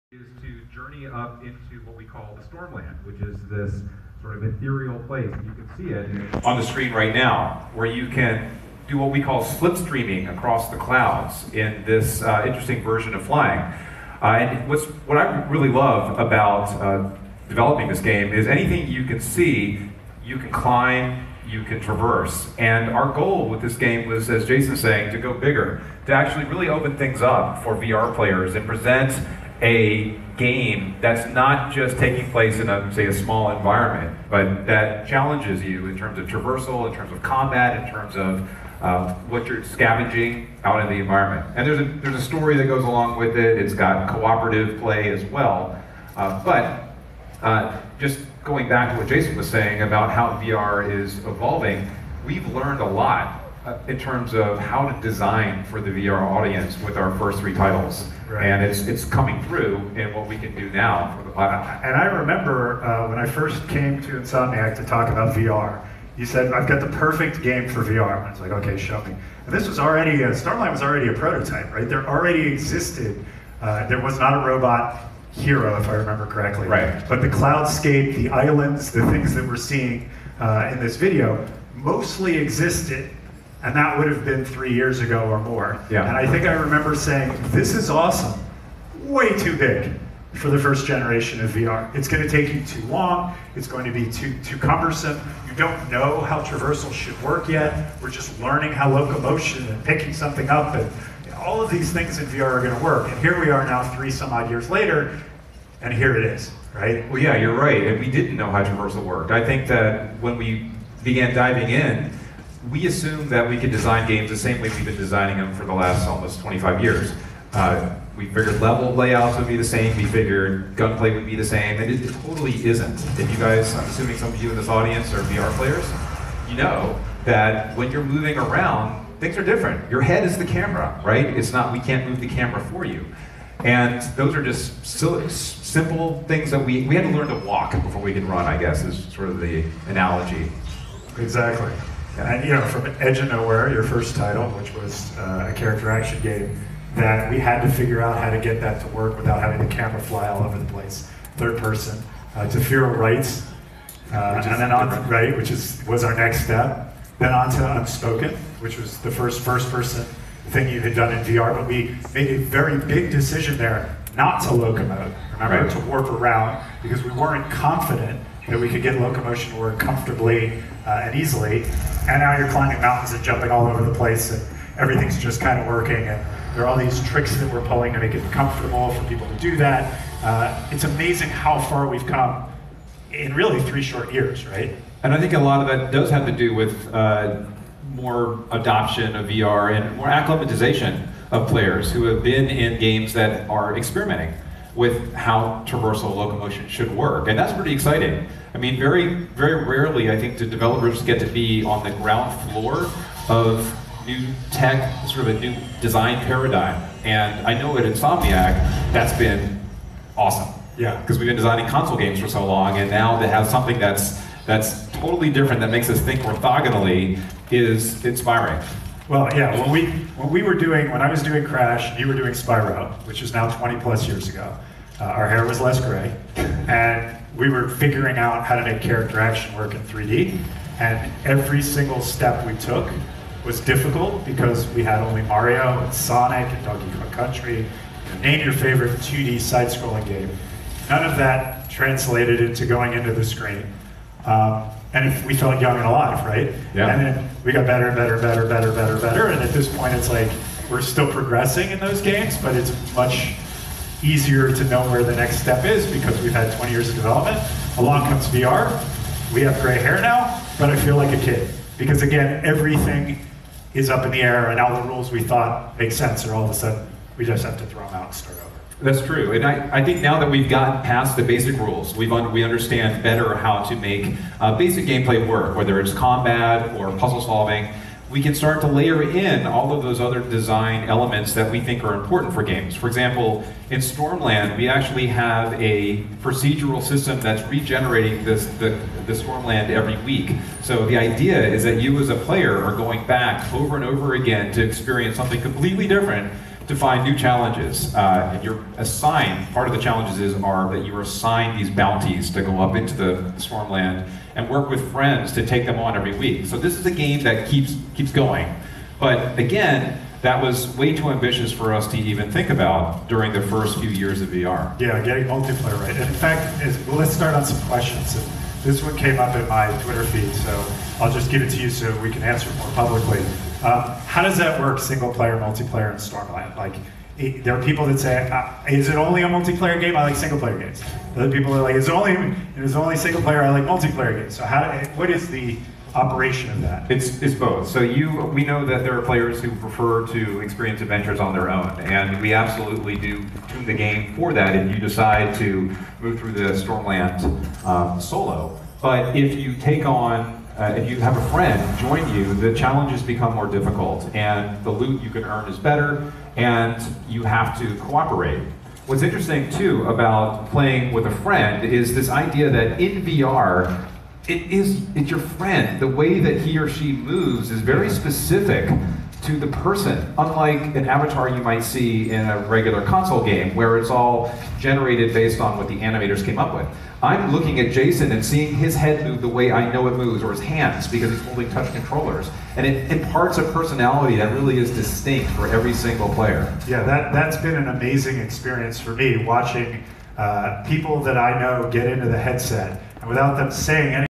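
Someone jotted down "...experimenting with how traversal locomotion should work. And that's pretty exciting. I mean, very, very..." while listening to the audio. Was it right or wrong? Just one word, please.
right.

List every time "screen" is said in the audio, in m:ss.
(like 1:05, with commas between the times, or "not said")
0:06, 4:03.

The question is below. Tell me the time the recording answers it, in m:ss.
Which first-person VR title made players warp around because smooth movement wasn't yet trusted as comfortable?
2:37.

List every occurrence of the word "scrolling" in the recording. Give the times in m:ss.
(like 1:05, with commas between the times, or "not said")
3:59.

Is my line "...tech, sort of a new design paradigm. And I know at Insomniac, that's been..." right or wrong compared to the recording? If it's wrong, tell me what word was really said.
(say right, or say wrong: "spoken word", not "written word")
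right.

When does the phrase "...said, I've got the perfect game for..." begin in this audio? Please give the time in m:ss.
1:06.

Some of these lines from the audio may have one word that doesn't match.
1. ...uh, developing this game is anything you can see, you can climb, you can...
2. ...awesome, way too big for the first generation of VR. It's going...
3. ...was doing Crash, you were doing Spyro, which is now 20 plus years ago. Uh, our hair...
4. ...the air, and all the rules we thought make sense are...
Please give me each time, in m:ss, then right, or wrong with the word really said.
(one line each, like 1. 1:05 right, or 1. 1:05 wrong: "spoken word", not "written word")
1. 0:16 right
2. 1:27 right
3. 3:41 right
4. 4:24 right.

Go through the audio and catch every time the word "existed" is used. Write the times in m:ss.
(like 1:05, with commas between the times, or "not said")
1:12, 1:22.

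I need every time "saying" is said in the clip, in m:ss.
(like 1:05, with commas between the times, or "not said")
0:24, 0:49, 1:26, 6:33.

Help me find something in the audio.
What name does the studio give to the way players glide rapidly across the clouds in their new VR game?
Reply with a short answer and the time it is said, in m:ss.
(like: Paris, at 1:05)
slipstreaming, at 0:09.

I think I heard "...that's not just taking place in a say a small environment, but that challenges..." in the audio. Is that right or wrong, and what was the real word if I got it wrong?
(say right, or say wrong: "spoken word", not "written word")
right.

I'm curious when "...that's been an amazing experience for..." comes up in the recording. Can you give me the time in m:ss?
6:27.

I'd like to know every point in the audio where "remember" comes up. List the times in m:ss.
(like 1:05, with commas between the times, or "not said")
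1:02, 1:15, 1:26, 2:45.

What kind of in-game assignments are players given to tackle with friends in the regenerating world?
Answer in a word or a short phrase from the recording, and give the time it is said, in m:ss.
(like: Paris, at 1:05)
bounties, at 5:01.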